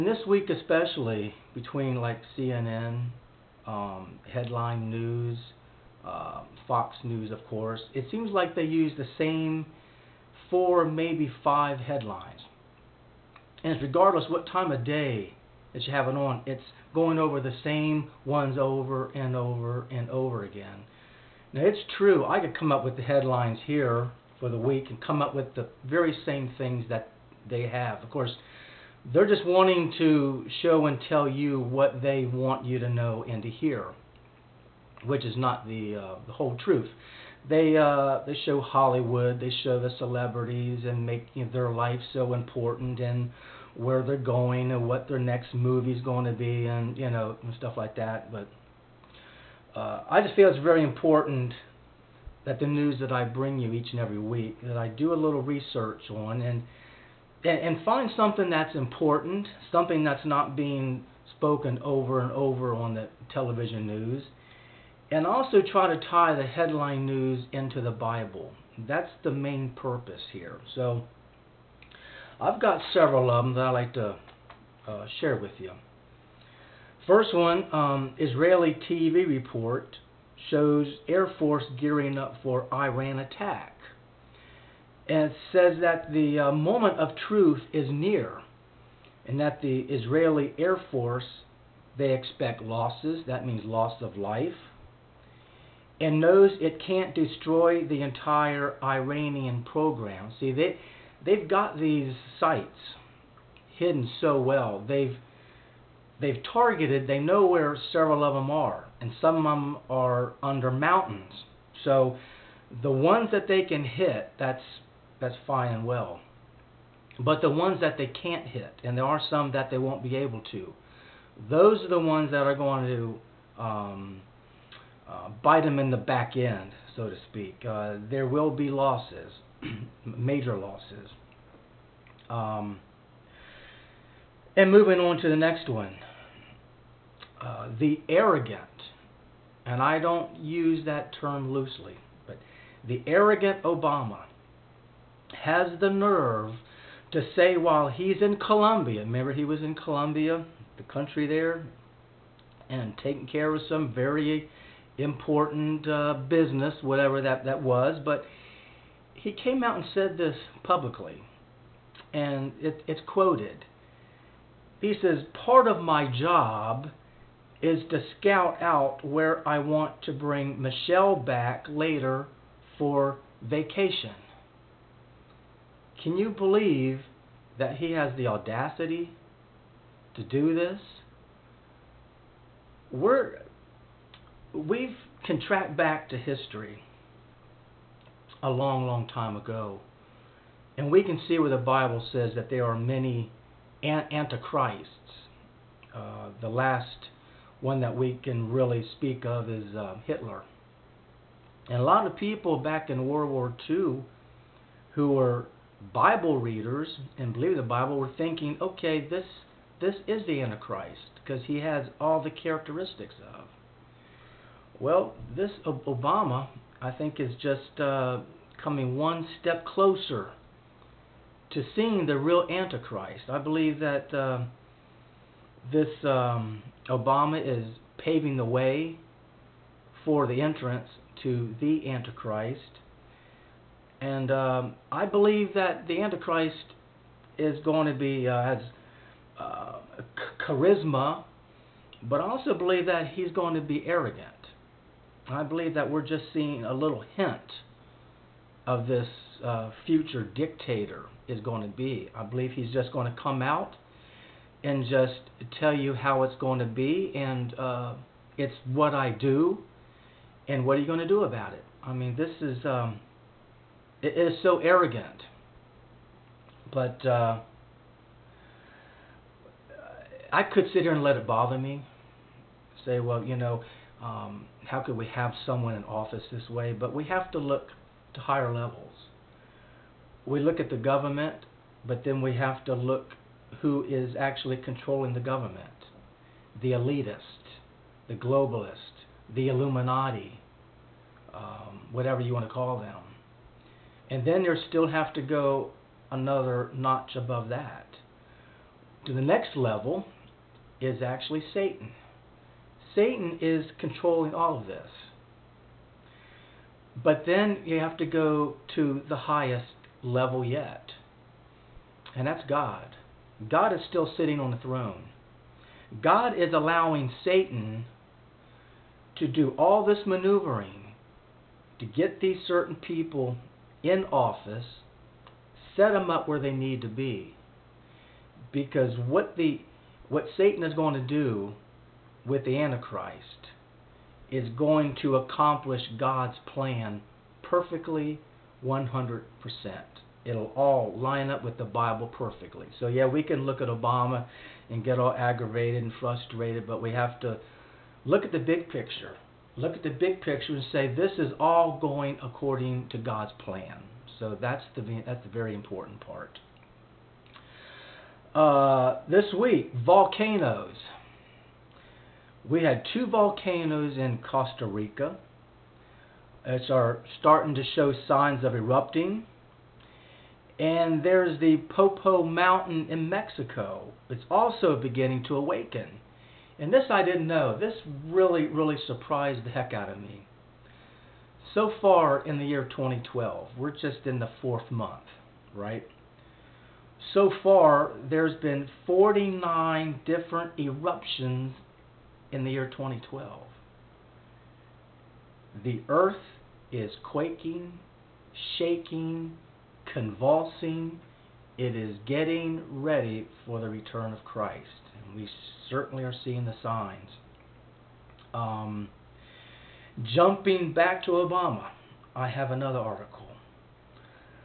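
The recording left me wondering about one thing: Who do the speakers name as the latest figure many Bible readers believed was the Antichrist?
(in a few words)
Hitler.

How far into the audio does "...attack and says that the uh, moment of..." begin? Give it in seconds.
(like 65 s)
83 s.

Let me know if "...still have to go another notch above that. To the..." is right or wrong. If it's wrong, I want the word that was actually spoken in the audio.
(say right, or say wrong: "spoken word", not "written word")
right.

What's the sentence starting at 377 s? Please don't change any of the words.
This really, really surprised the heck out of me.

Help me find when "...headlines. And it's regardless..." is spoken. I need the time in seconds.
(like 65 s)
11 s.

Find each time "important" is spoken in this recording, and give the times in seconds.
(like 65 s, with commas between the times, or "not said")
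42 s, 50 s, 58 s, 154 s, 355 s.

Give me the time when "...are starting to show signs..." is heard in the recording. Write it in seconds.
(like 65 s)
366 s.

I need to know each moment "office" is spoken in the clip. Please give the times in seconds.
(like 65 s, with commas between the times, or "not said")
275 s, 324 s.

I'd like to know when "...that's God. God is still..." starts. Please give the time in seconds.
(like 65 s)
312 s.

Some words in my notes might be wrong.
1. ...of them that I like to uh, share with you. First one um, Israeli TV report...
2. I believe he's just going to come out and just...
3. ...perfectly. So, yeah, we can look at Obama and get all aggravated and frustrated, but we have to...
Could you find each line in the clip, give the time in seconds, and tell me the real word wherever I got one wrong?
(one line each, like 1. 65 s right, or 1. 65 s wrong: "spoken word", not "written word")
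1. 73 s right
2. 252 s right
3. 342 s right.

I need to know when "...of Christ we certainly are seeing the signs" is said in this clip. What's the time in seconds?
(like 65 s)
404 s.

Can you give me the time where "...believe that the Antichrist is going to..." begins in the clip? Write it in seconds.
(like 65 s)
235 s.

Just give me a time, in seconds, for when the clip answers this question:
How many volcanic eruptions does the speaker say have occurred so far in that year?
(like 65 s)
388 s.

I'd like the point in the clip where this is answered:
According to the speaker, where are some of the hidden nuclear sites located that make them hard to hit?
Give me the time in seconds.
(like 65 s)
110 s.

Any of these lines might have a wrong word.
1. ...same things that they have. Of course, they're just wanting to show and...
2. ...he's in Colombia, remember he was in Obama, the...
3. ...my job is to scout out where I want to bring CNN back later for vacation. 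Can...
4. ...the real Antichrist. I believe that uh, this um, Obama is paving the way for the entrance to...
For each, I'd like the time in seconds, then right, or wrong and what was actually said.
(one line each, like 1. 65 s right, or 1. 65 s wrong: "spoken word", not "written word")
1. 26 s right
2. 147 s wrong: "Colombia", not "Obama"
3. 165 s wrong: "Michelle", not "CNN"
4. 222 s right.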